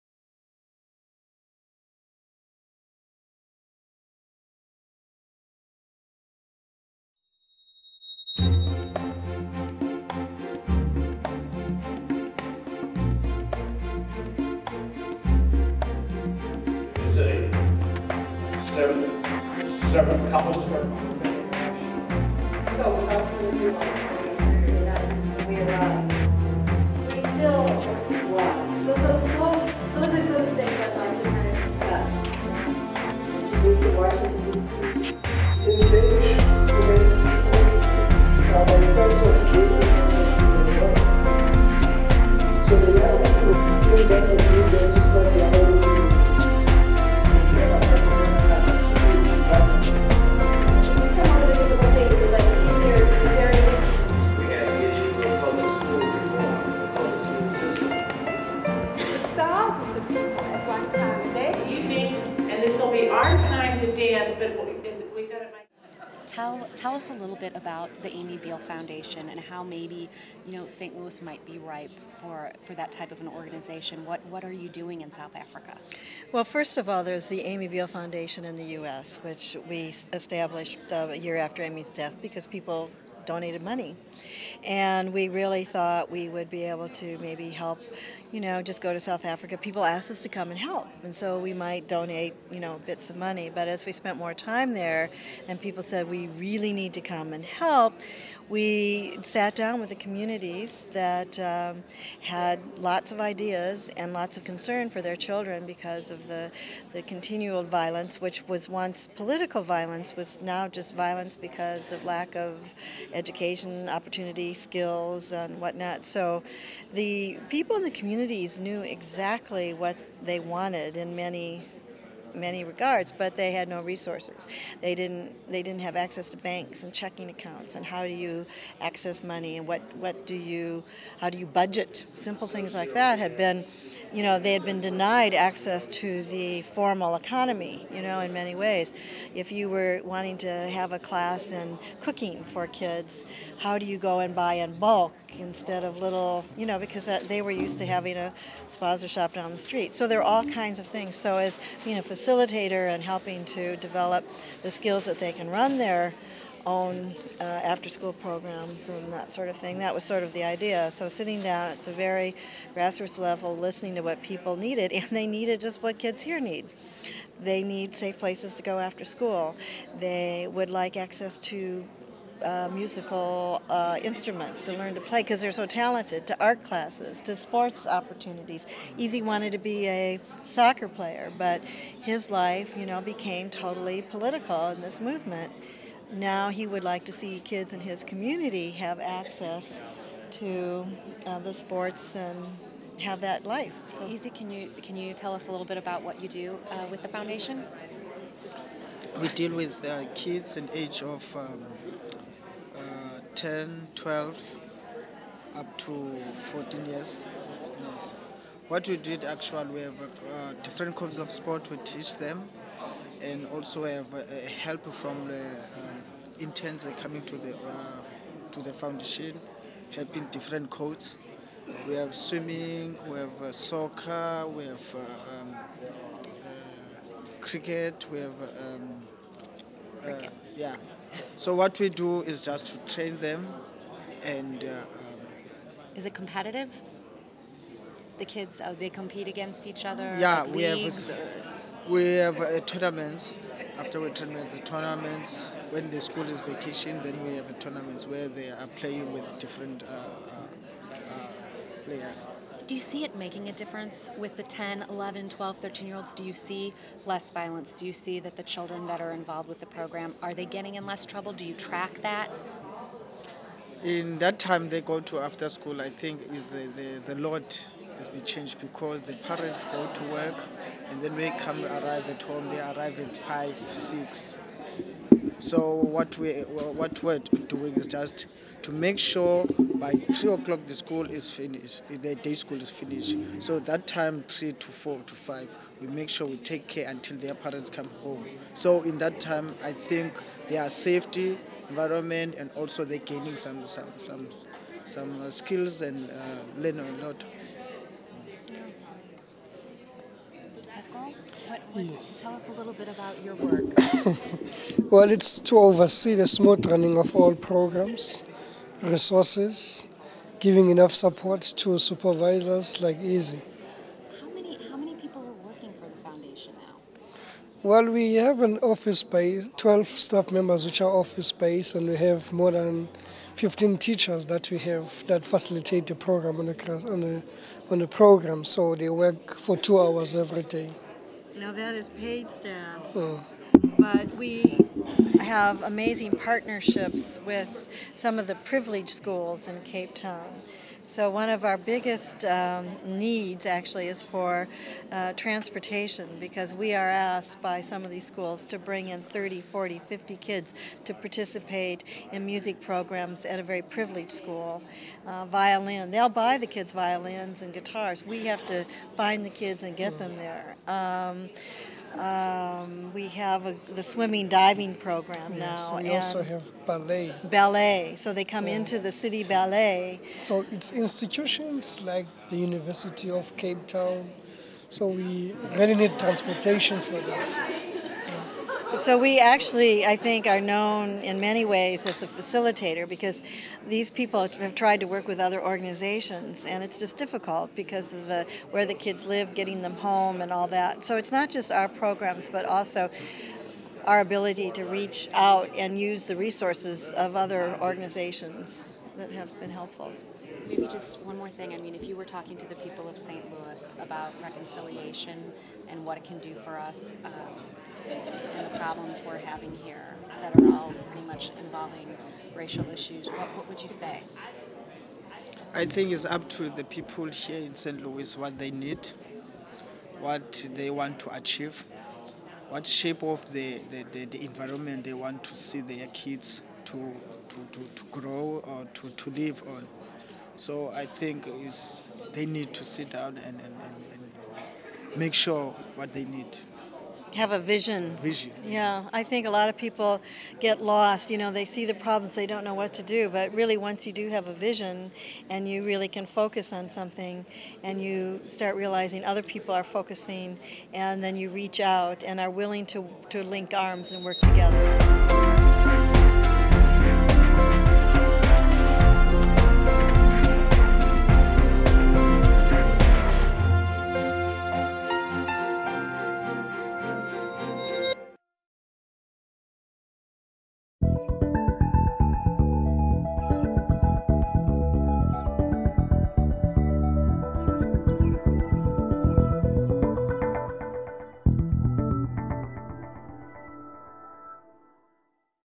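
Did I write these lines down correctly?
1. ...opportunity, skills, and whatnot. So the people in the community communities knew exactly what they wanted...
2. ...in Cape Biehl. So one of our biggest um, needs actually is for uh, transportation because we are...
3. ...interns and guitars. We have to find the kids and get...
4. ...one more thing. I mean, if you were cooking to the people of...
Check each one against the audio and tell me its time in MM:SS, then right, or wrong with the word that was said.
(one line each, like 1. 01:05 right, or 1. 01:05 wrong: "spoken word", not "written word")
1. 01:53 right
2. 05:39 wrong: "Town", not "Biehl"
3. 05:56 wrong: "violins", not "interns"
4. 06:41 wrong: "talking", not "cooking".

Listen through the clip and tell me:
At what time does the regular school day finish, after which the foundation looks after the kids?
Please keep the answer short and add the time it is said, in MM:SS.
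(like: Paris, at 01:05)
3 o'clock, at 04:40.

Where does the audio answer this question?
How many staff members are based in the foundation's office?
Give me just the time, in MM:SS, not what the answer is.
05:19.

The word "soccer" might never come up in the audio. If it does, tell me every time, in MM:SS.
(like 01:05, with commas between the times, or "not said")
03:00, 03:43.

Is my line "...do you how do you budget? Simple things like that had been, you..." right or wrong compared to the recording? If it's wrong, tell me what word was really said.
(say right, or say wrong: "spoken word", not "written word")
right.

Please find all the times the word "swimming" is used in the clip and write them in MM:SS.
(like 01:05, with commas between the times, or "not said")
03:42, 06:03.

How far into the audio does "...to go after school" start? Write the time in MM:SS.
02:48.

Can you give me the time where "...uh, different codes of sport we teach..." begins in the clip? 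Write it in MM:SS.
03:29.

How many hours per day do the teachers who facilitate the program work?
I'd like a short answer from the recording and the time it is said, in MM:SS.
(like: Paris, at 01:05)
2, at 05:29.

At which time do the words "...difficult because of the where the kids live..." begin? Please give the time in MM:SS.
06:26.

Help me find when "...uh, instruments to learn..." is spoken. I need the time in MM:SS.
02:53.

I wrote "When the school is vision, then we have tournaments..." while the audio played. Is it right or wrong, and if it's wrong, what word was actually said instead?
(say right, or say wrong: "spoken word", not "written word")
wrong: "vacation", not "vision".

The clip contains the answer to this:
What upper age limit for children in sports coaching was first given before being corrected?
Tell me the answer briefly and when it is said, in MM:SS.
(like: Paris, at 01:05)
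14, at 03:26.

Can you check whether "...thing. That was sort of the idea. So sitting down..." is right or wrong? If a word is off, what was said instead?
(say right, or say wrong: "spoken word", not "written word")
right.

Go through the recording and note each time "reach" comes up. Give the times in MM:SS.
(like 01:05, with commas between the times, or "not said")
06:34, 07:31.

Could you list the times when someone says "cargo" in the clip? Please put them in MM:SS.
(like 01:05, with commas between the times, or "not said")
not said.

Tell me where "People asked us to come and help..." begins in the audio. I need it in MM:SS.
01:29.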